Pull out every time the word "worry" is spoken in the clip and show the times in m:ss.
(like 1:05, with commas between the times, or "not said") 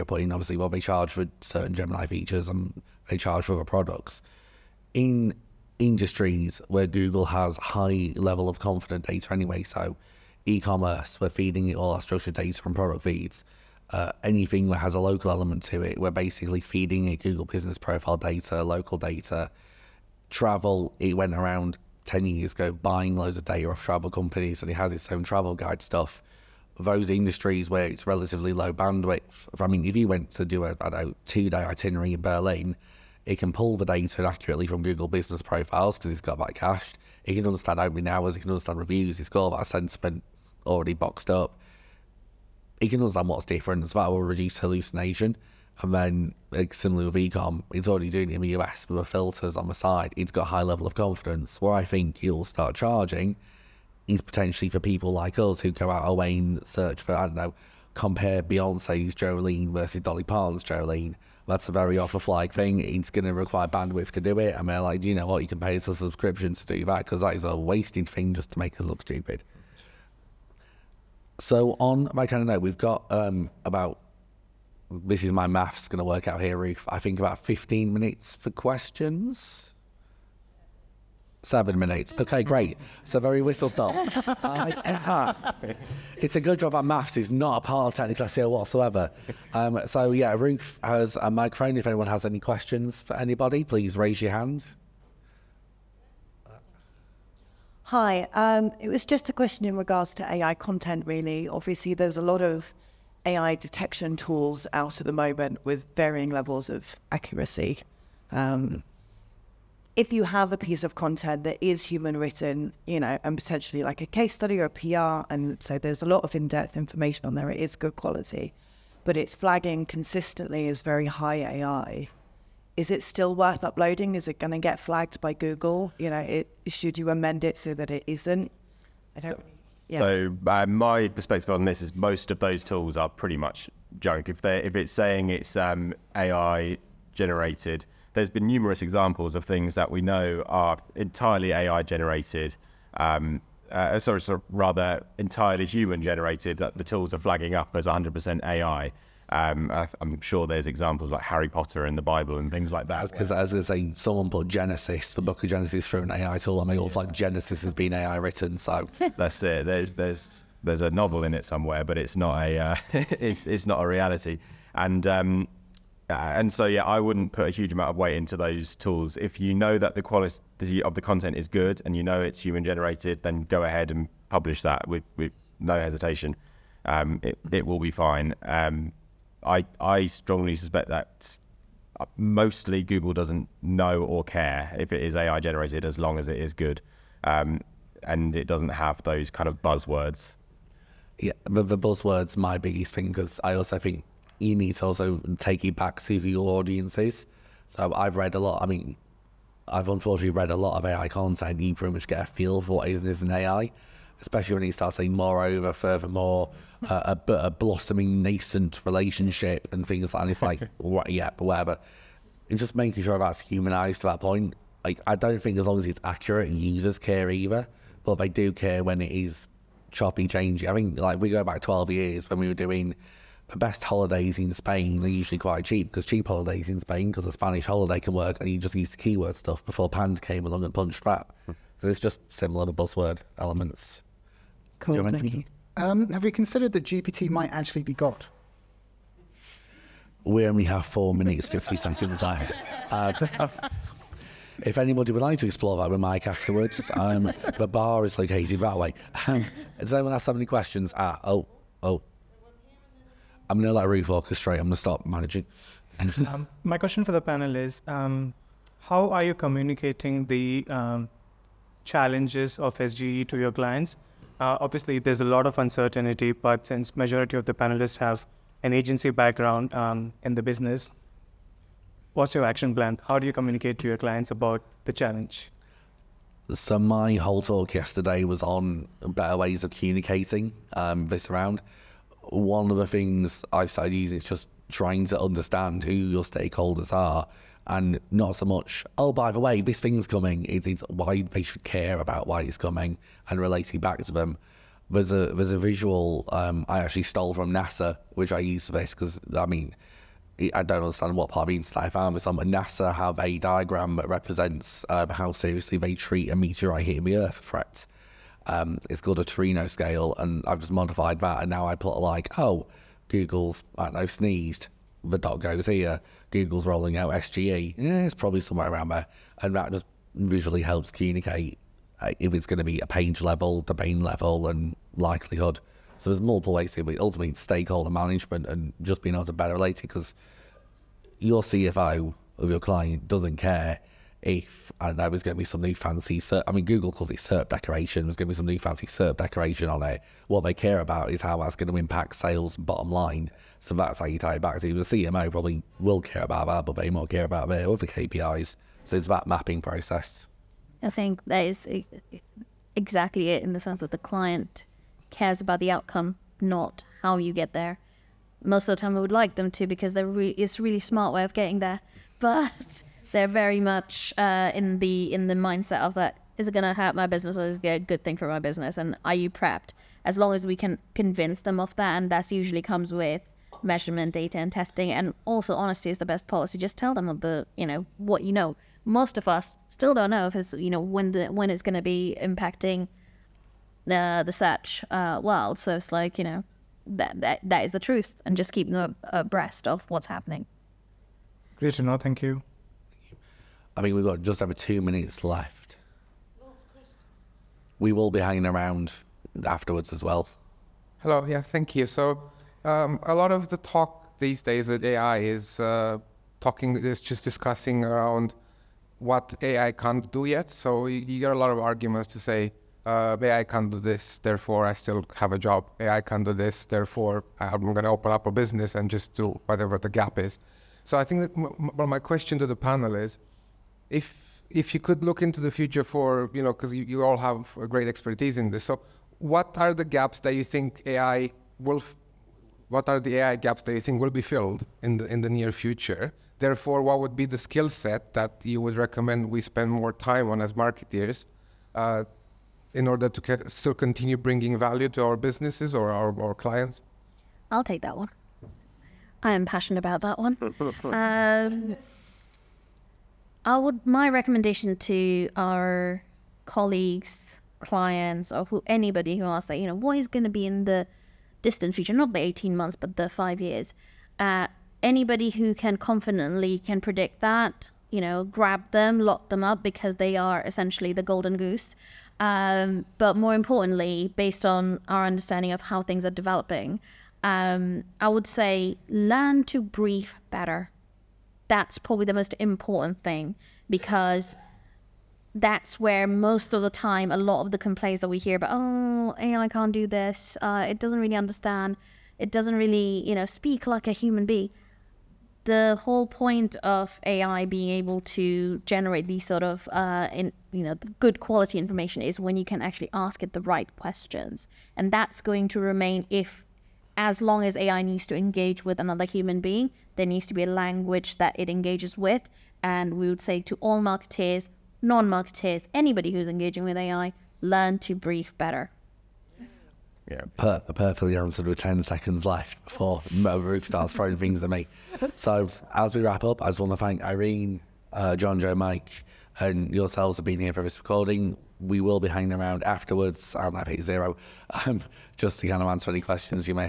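not said.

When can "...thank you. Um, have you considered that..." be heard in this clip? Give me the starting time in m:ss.
3:55.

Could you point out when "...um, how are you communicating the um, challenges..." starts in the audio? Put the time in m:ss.
4:17.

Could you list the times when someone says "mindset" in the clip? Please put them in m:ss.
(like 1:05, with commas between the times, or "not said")
6:05.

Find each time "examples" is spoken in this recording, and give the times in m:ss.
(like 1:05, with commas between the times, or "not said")
2:18, 2:30.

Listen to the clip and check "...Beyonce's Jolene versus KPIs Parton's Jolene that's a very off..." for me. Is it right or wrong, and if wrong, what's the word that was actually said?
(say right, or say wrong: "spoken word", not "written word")
wrong: "Dolly", not "KPIs".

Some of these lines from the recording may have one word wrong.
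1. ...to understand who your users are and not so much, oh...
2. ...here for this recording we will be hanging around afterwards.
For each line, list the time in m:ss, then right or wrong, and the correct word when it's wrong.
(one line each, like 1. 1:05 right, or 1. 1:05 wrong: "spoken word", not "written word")
1. 4:45 wrong: "stakeholders", not "users"
2. 8:50 right.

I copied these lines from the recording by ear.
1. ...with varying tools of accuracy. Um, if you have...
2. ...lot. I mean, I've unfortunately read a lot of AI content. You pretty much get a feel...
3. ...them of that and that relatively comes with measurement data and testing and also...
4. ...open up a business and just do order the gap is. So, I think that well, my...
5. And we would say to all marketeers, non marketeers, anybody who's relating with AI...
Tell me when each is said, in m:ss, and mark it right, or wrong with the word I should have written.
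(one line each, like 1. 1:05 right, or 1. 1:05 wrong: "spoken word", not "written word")
1. 1:45 wrong: "levels", not "tools"
2. 3:18 right
3. 6:11 wrong: "usually", not "relatively"
4. 6:57 wrong: "whatever", not "order"
5. 8:32 wrong: "engaging", not "relating".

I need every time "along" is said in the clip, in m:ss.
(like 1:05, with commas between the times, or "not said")
3:50.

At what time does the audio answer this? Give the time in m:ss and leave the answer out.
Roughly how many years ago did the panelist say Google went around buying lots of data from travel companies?
0:22.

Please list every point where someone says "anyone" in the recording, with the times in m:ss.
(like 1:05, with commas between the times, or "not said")
1:31, 4:09.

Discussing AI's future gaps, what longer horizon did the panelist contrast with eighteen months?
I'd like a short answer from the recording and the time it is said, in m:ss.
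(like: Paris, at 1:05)
5 years, at 7:43.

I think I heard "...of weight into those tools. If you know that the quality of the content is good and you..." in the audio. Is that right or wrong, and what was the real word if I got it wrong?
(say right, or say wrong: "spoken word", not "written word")
right.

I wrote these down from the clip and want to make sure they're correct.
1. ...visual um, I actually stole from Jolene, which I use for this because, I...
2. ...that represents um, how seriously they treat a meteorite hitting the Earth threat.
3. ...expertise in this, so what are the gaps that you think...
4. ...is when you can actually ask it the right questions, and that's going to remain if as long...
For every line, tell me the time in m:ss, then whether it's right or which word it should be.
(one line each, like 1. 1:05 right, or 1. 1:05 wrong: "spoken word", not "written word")
1. 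4:55 wrong: "NASA", not "Jolene"
2. 5:03 right
3. 7:07 right
4. 8:22 right.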